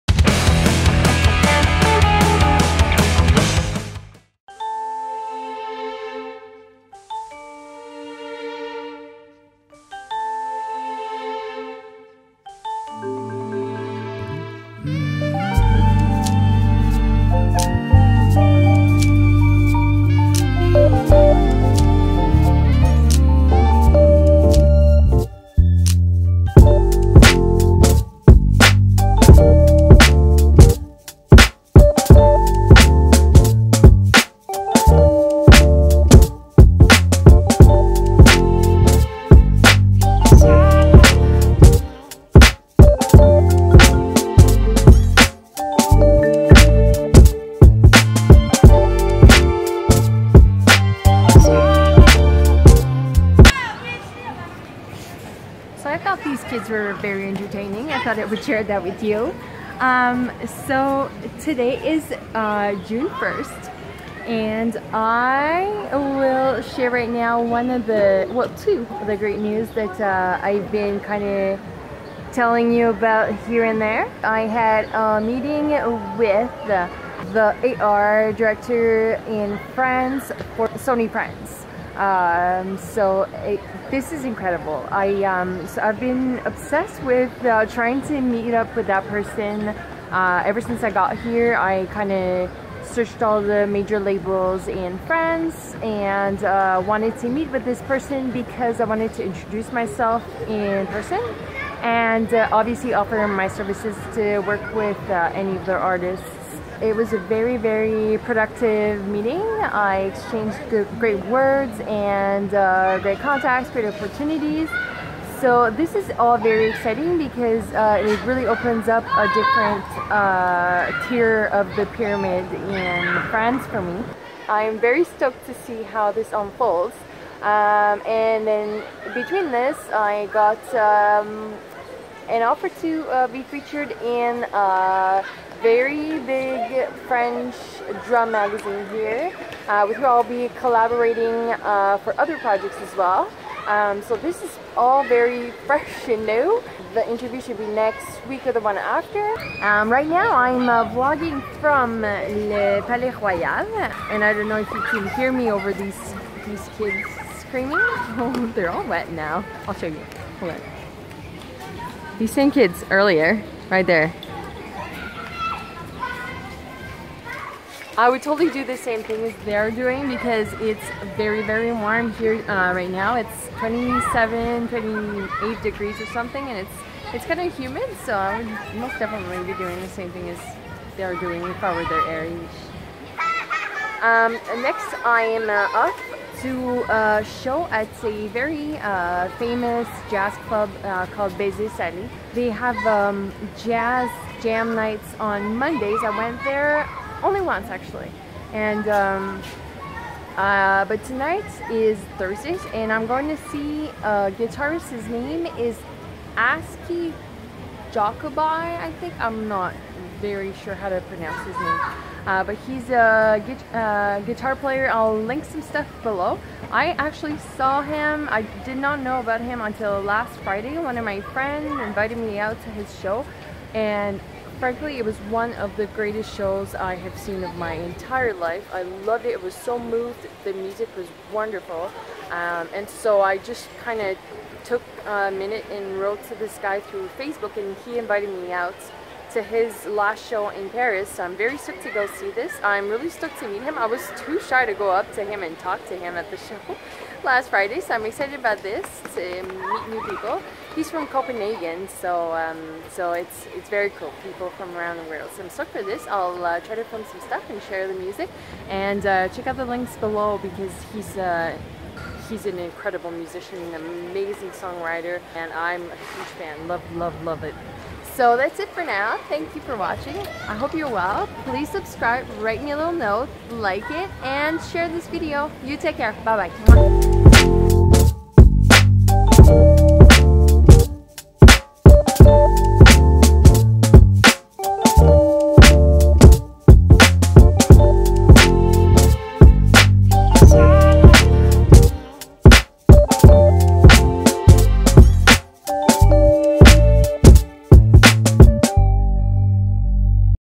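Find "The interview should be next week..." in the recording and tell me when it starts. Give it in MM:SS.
02:26.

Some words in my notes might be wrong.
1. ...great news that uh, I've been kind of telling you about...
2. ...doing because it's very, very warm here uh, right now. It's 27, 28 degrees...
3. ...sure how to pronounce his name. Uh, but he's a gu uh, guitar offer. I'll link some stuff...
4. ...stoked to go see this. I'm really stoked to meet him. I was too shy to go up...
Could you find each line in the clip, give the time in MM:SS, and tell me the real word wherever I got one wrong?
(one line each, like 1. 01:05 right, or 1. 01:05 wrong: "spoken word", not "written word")
1. 01:09 right
2. 02:49 right
3. 03:30 wrong: "player", not "offer"
4. 04:01 right.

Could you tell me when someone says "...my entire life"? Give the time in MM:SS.
03:47.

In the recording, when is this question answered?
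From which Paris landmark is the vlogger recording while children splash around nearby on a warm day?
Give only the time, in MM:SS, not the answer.
02:32.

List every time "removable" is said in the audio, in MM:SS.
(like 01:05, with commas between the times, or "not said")
not said.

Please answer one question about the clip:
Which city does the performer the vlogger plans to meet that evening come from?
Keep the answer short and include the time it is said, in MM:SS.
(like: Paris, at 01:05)
Copenhagen, at 04:11.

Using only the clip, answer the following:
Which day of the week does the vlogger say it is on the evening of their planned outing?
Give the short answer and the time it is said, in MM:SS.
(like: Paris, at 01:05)
Thursday, at 03:22.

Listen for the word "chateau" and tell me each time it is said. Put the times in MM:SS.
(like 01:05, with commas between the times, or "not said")
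not said.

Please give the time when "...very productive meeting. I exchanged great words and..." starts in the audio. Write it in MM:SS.
01:47.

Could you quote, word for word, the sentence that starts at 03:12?
They have um, jazz jam nights on Mondays.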